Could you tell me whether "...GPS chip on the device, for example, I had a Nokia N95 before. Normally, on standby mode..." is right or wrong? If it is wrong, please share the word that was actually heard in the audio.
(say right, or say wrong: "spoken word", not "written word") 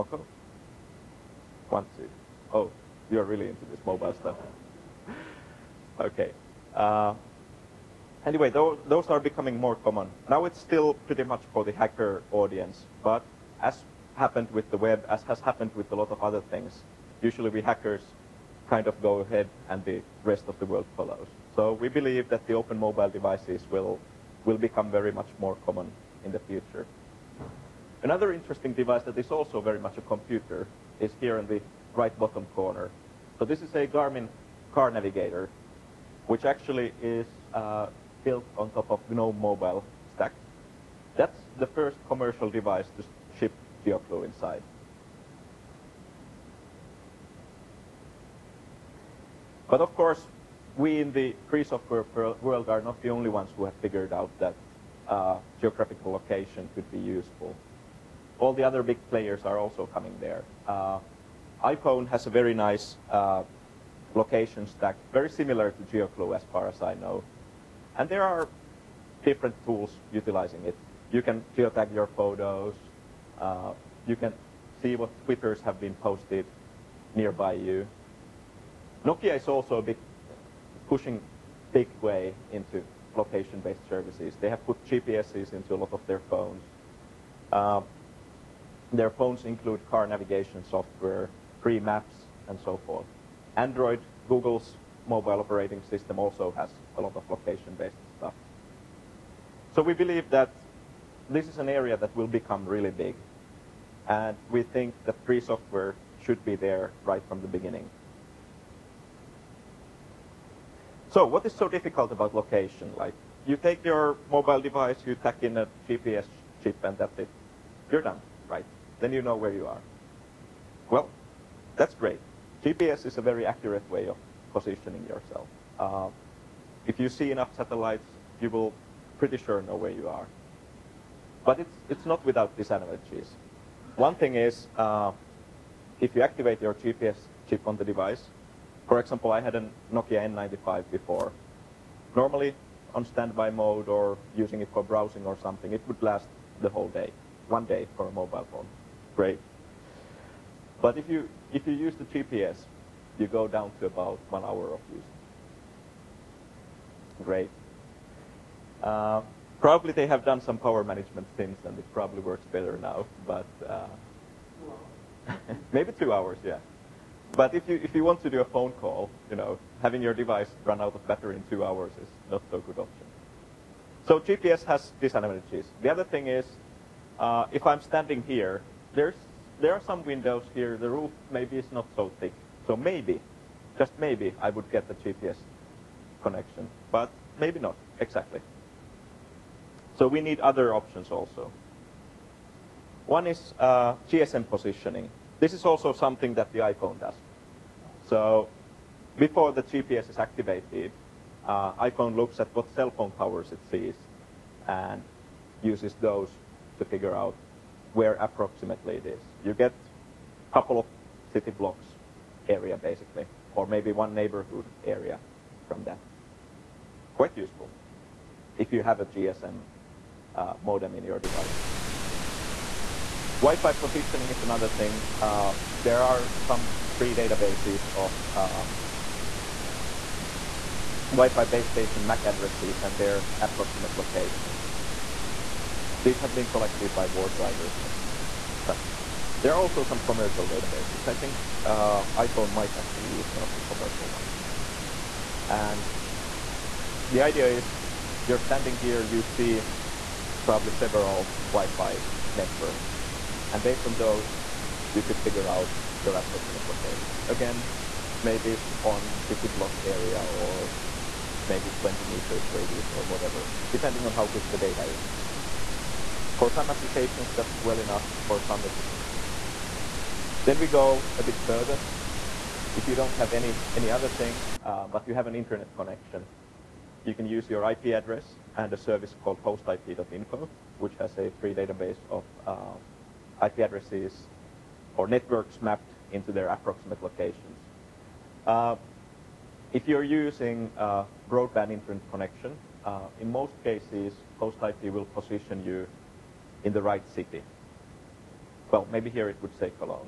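right.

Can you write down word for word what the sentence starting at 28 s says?
Another interesting device that is also very much a computer is here in the right bottom corner.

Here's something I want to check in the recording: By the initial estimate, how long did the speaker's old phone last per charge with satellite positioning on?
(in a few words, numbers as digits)
1 hour.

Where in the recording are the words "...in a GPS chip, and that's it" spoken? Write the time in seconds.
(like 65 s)
115 s.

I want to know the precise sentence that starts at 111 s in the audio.
So what is so difficult about location?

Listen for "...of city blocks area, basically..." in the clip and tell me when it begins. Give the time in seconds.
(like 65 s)
210 s.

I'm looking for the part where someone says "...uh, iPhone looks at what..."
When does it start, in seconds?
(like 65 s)
201 s.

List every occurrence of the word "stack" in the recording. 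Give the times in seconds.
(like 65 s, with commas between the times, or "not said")
40 s, 64 s.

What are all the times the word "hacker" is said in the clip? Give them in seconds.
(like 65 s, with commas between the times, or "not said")
11 s, 17 s.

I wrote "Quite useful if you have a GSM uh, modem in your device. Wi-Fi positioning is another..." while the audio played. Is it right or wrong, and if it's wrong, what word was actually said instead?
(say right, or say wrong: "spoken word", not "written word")
right.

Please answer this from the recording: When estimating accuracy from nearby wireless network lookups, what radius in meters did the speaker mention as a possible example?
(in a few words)
20 meters.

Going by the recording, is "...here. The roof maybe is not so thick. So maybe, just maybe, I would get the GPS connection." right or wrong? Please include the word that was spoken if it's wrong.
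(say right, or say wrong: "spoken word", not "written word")
right.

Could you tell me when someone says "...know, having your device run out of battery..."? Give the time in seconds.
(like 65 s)
169 s.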